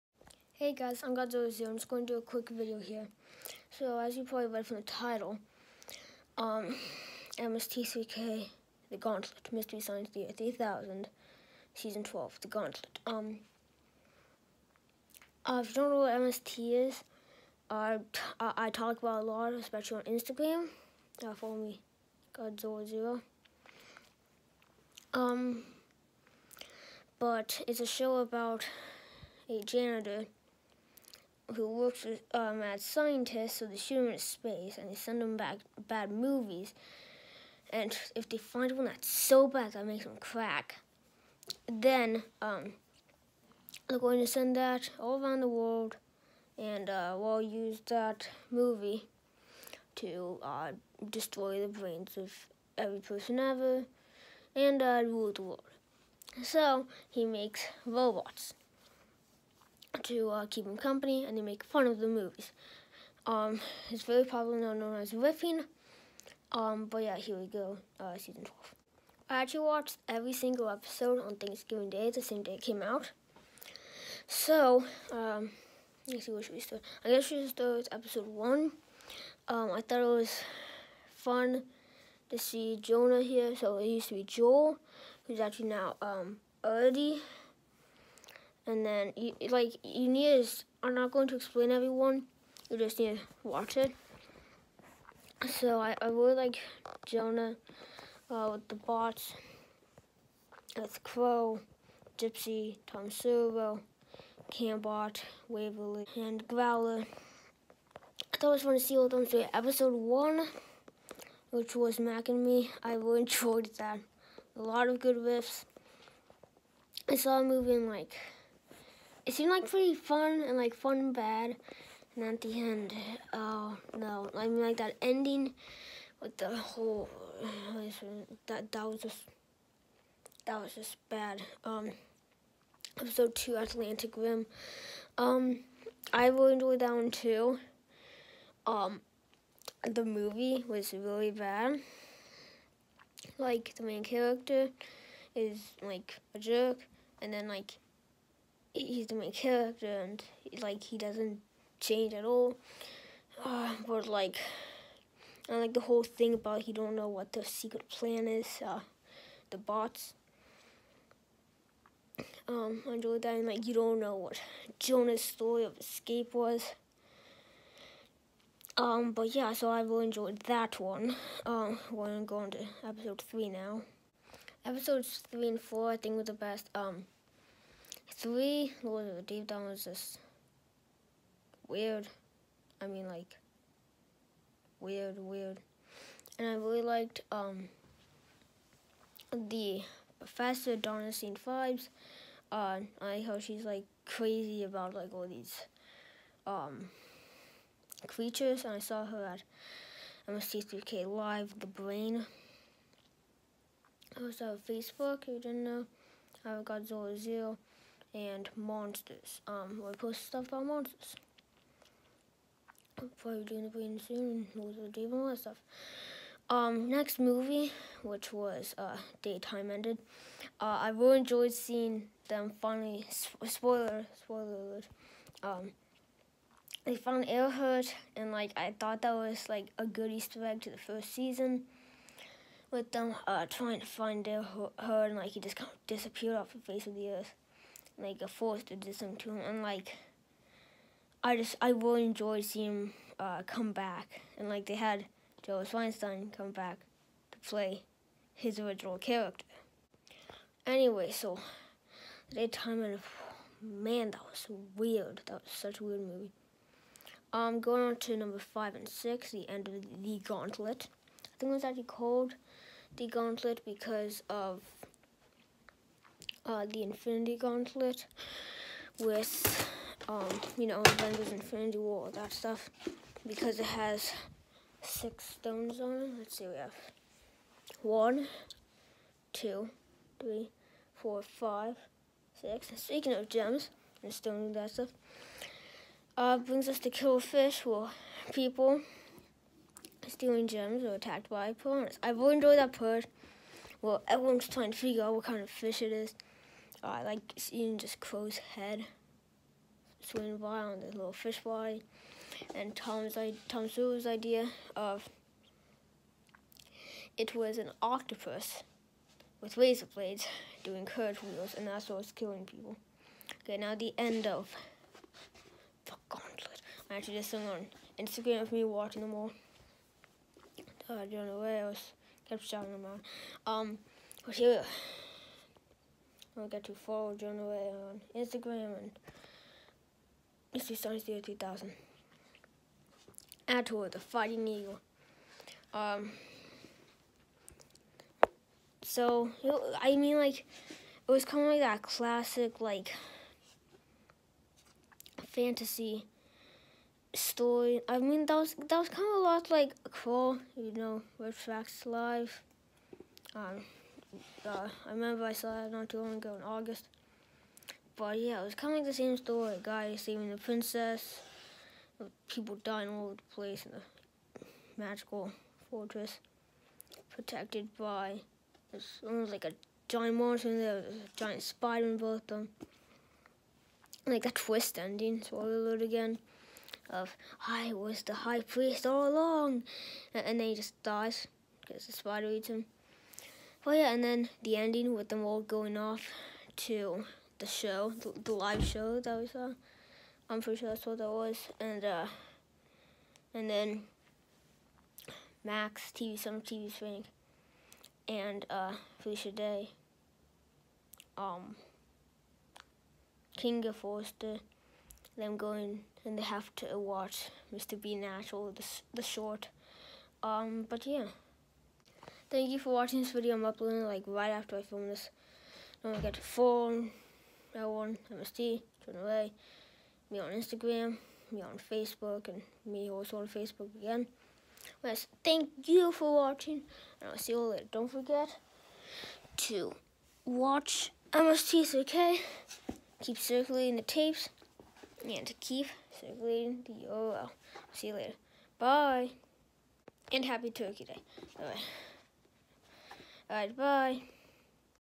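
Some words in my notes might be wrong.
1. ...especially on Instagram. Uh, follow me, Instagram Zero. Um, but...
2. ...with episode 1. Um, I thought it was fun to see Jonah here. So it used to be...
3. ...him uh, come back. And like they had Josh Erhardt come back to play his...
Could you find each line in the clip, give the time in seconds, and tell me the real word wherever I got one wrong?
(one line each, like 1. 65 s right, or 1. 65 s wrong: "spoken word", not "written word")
1. 19 s wrong: "Godzilla", not "Instagram"
2. 77 s right
3. 242 s wrong: "Weinstein", not "Erhardt".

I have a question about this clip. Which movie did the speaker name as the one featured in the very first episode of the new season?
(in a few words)
Mac and Me.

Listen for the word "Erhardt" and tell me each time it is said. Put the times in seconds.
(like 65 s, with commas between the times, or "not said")
227 s, 234 s.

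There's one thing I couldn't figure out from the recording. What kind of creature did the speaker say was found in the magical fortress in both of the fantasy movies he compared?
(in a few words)
A giant spider.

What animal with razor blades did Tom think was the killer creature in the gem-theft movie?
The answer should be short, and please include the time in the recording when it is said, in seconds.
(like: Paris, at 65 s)
An octopus, at 307 s.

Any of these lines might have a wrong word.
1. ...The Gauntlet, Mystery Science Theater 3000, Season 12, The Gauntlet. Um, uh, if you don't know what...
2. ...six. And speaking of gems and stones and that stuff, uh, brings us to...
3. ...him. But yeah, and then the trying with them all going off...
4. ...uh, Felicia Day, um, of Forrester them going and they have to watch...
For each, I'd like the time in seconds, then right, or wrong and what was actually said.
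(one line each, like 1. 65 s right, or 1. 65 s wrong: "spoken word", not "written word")
1. 8 s right
2. 282 s right
3. 382 s wrong: "ending", not "trying"
4. 398 s right.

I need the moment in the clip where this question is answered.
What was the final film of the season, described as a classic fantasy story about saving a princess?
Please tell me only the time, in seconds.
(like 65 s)
333 s.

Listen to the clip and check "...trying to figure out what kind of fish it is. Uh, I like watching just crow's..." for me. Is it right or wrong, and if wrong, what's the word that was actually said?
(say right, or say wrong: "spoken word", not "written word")
wrong: "seeing", not "watching".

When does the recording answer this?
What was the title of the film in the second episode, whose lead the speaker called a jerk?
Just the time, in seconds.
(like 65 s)
133 s.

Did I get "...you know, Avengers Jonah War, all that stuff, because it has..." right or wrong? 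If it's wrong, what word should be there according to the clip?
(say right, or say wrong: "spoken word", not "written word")
wrong: "Infinity", not "Jonah".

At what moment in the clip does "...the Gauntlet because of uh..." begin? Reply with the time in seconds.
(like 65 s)
262 s.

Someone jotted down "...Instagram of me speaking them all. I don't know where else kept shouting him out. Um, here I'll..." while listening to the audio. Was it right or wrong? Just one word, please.
wrong.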